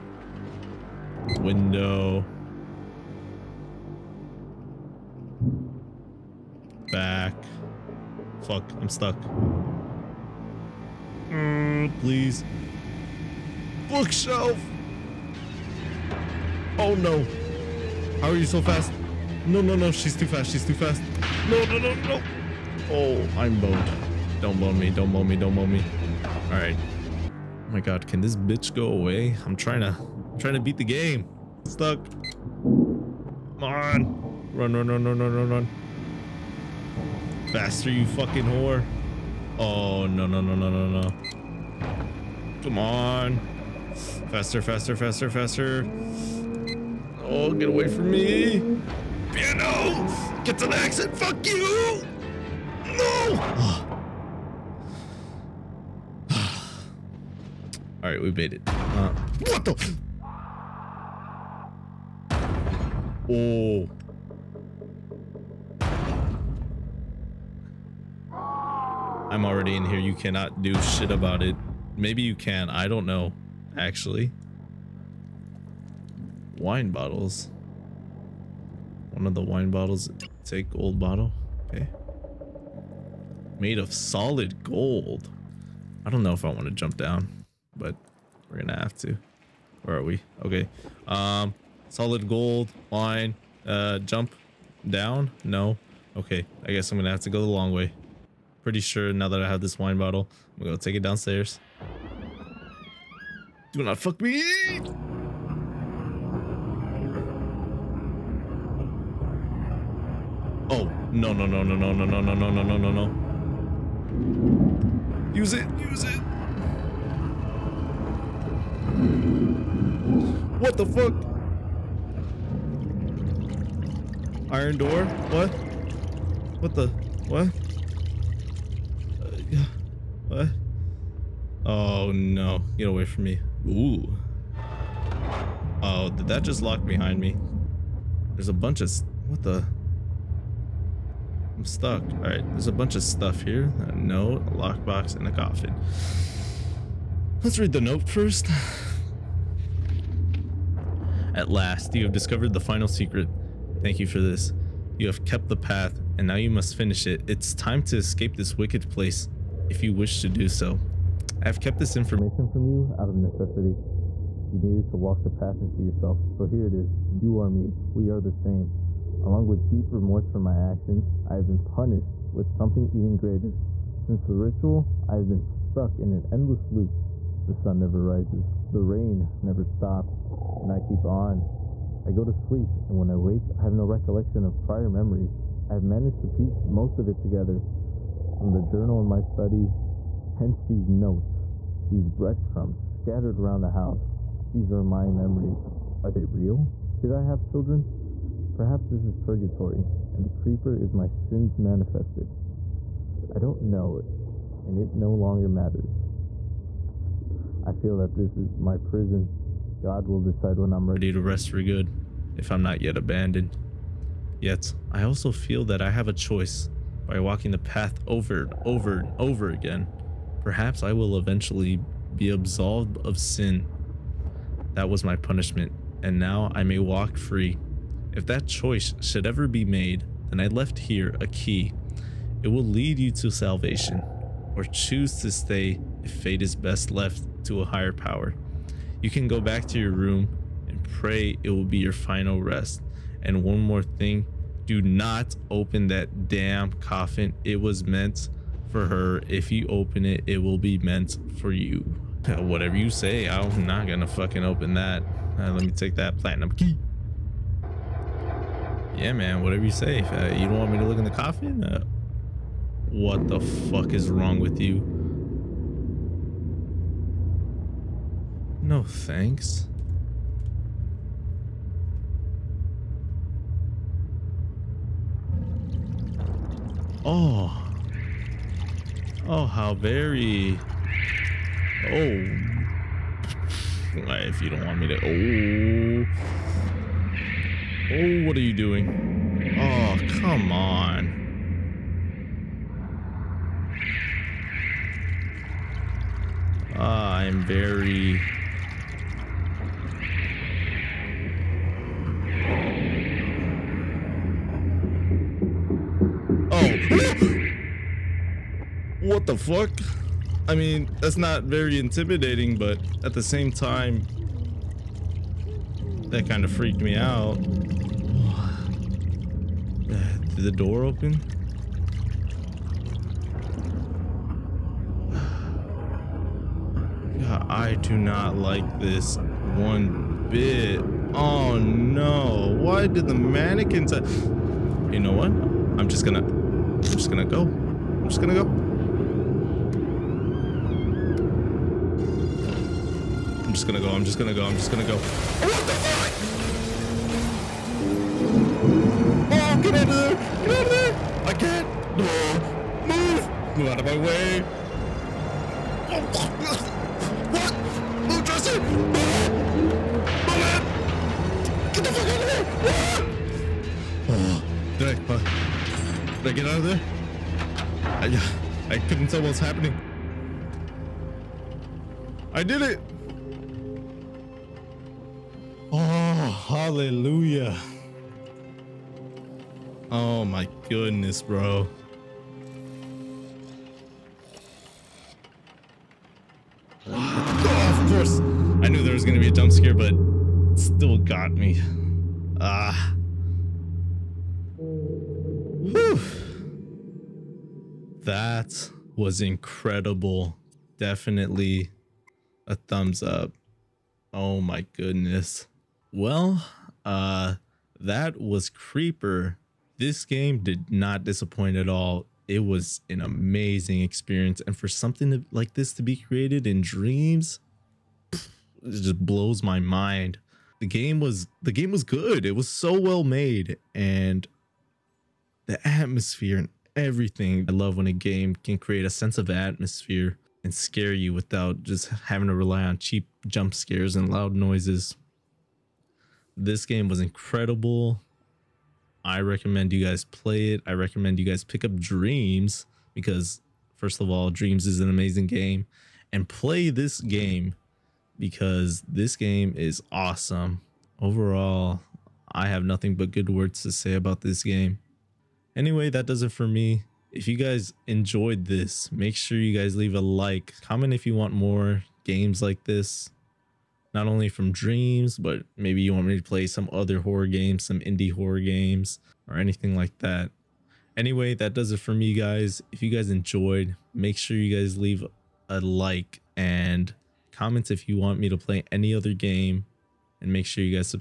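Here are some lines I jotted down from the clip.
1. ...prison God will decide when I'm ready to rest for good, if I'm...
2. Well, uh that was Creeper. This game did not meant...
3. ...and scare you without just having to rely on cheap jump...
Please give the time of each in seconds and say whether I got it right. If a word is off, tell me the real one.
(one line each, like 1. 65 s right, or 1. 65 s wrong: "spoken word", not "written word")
1. 208 s right
2. 405 s wrong: "disappoint", not "meant"
3. 430 s right.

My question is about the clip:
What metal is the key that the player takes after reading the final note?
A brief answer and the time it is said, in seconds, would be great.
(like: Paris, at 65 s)
Platinum, at 256 s.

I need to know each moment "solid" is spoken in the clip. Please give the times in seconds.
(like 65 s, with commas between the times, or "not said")
83 s, 91 s.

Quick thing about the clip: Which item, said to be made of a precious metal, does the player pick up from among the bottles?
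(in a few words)
Old bottle.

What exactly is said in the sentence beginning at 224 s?
That was my punishment, and now I may walk free.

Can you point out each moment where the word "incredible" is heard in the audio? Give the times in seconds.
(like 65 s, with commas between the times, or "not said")
399 s, 436 s.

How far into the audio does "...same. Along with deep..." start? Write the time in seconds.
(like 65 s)
168 s.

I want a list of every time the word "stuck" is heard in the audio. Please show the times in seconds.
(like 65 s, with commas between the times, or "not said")
8 s, 31 s, 141 s, 175 s.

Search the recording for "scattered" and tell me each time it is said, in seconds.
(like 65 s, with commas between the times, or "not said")
192 s.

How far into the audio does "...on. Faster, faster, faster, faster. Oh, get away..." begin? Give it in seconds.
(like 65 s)
42 s.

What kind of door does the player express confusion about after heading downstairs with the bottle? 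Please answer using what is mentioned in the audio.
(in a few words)
Iron door.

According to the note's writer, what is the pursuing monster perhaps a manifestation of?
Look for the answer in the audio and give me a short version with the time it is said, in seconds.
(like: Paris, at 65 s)
My sins, at 200 s.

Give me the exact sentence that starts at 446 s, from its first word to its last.
And play this game because this game is awesome.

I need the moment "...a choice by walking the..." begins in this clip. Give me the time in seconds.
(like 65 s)
216 s.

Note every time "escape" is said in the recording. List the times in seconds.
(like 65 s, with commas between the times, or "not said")
157 s.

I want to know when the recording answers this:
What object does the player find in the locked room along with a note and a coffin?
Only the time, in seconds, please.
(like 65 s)
144 s.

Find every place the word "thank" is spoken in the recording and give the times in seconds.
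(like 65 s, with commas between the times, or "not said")
153 s, 268 s.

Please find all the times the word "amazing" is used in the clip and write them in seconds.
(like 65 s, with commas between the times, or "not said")
413 s, 444 s.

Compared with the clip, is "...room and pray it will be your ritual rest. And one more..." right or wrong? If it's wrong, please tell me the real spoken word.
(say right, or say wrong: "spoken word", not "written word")
wrong: "final", not "ritual".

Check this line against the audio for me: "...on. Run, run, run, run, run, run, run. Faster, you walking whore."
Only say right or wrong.
wrong.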